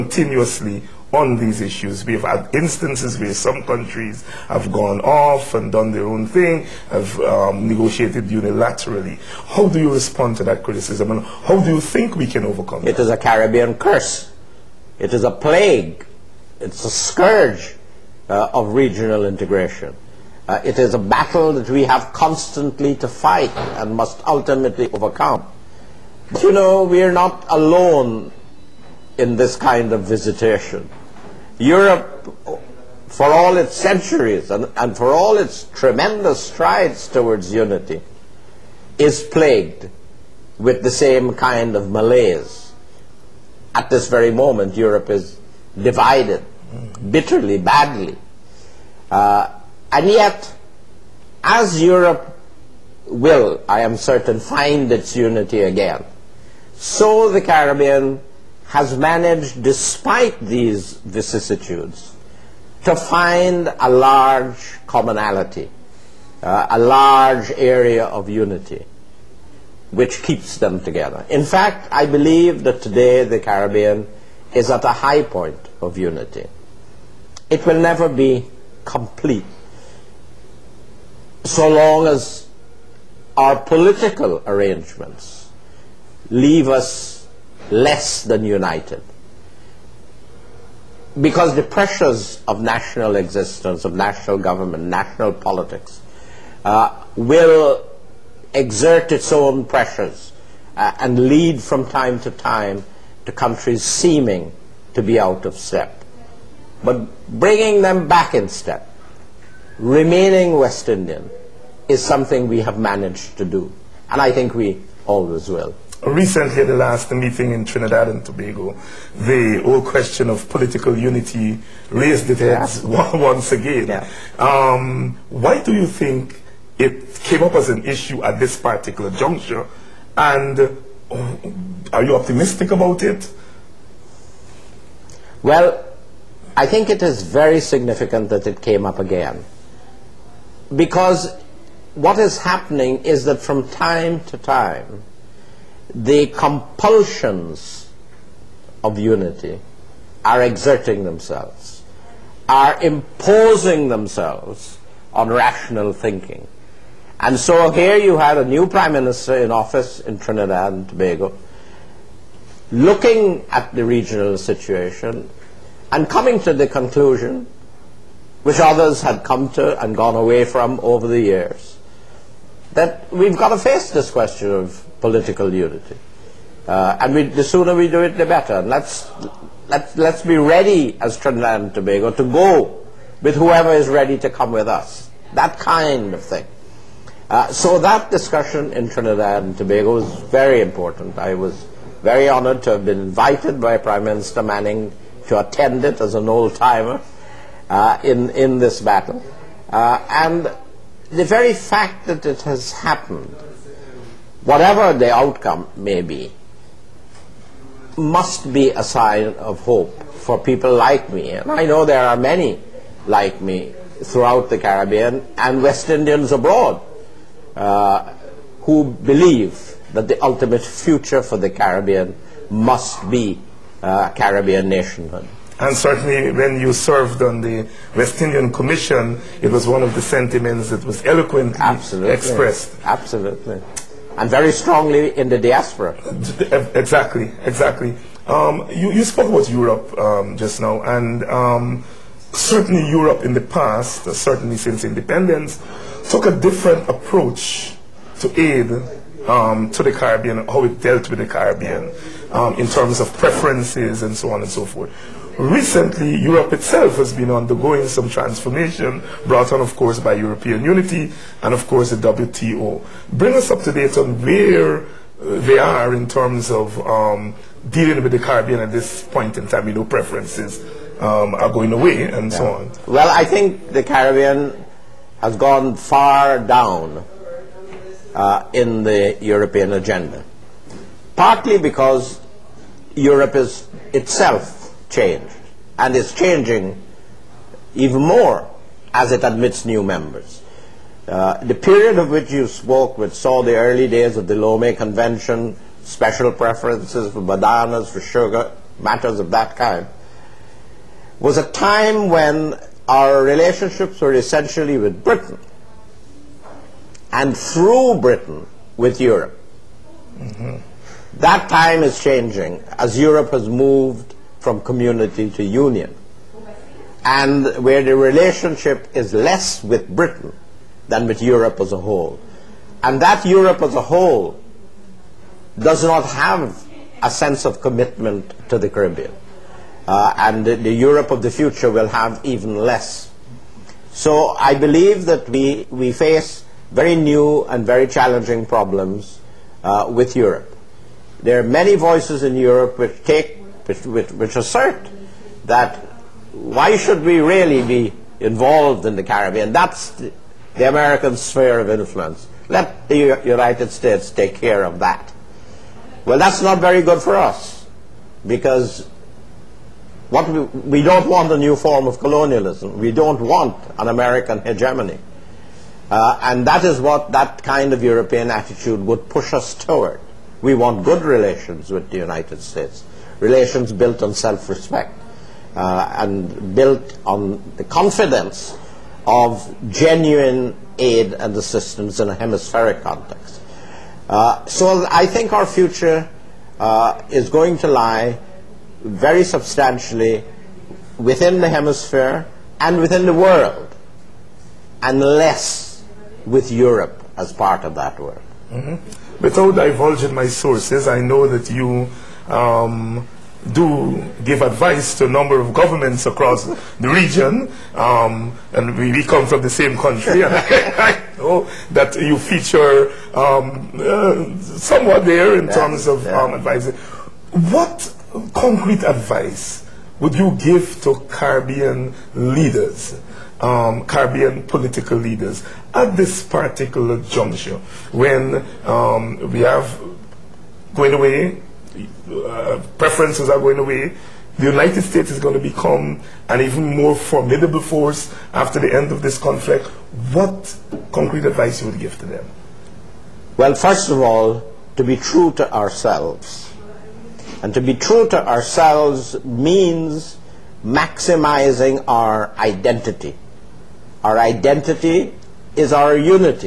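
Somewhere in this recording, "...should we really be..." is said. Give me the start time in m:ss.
5:46.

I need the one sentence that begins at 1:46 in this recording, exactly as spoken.
But bringing them back in step, remaining West Indian, is something we have managed to do.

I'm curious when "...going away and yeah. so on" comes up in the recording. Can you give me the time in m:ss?
4:31.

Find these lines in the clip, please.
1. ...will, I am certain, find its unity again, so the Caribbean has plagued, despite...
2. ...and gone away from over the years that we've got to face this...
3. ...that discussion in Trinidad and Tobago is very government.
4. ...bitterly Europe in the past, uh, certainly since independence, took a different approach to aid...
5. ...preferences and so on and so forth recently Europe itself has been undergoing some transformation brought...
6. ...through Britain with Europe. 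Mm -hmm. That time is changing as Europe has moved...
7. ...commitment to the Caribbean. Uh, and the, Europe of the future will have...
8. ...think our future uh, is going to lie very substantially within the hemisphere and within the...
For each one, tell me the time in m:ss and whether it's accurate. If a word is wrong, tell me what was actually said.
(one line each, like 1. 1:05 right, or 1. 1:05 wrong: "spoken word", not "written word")
1. 0:53 wrong: "managed", not "plagued"
2. 2:49 right
3. 3:07 wrong: "important", not "government"
4. 4:02 wrong: "certainly", not "bitterly"
5. 4:13 right
6. 5:07 right
7. 5:27 right
8. 6:25 right.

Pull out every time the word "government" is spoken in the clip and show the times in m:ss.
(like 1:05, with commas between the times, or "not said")
1:34, 6:45.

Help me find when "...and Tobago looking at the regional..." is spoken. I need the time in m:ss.
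2:40.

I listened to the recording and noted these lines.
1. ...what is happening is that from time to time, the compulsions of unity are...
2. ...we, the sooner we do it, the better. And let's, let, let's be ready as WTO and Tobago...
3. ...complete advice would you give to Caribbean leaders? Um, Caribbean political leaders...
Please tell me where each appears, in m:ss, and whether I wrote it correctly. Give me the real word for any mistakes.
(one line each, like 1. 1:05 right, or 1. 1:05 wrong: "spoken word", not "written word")
1. 2:21 right
2. 2:57 wrong: "Trinidad", not "WTO"
3. 6:58 wrong: "concrete", not "complete".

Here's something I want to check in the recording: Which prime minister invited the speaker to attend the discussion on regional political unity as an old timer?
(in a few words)
Manning.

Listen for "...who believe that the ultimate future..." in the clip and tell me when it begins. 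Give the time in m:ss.
3:38.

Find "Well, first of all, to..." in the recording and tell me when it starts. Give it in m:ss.
7:23.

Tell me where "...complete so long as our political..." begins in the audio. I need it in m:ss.
1:18.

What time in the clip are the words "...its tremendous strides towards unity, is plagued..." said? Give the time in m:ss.
0:35.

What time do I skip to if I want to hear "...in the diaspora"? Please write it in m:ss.
3:55.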